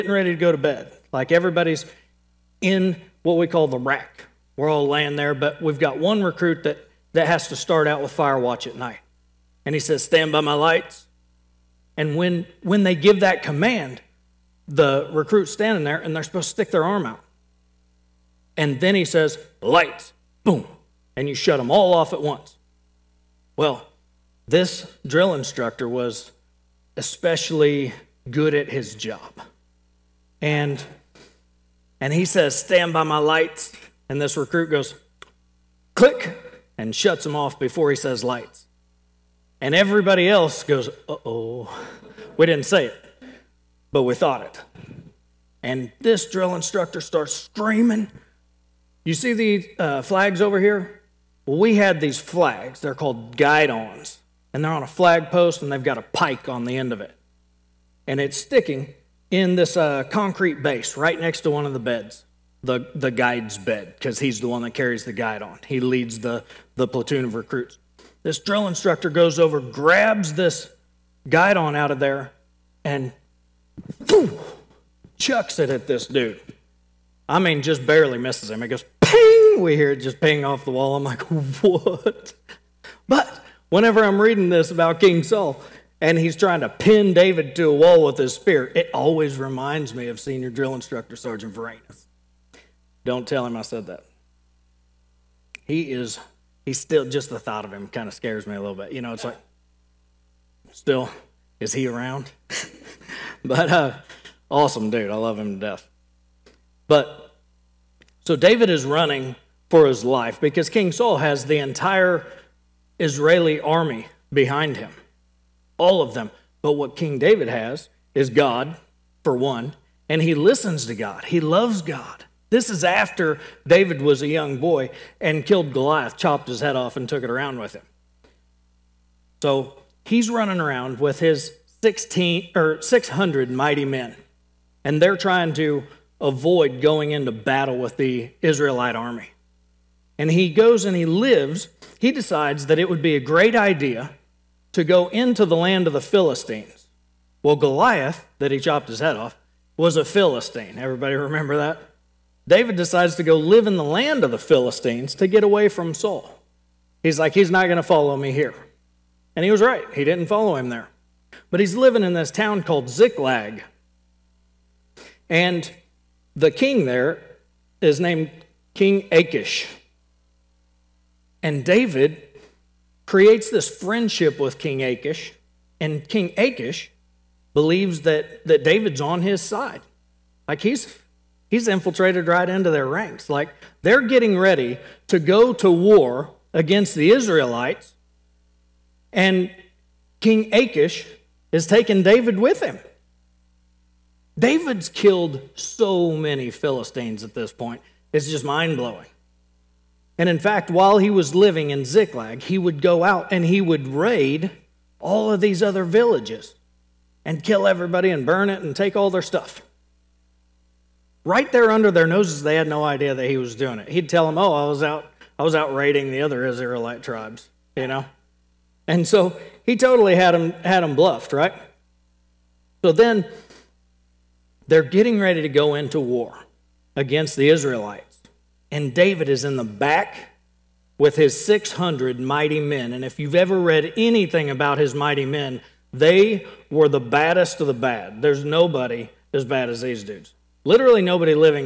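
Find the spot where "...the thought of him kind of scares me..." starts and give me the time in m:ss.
1:37.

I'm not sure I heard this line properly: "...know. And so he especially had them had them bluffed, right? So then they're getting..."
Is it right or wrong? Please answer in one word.
wrong.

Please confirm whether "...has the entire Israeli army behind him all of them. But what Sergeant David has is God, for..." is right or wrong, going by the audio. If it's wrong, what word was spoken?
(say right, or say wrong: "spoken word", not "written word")
wrong: "King", not "Sergeant".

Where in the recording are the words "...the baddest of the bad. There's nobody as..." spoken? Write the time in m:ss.
3:56.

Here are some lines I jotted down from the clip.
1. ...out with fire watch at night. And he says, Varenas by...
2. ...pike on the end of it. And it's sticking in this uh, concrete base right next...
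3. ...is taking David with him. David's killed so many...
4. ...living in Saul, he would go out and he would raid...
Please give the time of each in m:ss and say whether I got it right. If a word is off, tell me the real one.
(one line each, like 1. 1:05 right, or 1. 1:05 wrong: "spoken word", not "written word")
1. 0:07 wrong: "Stand", not "Varenas"
2. 0:56 right
3. 3:11 right
4. 3:21 wrong: "Ziklag", not "Saul".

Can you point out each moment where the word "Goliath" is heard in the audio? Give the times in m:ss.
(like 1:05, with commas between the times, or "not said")
2:05, 2:27.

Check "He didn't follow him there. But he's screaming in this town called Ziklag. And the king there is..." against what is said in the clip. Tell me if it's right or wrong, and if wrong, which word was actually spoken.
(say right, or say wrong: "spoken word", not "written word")
wrong: "living", not "screaming".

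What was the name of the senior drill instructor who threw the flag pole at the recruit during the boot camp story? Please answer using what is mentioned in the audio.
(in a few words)
Sergeant Varenas.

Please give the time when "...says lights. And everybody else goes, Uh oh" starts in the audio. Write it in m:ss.
0:37.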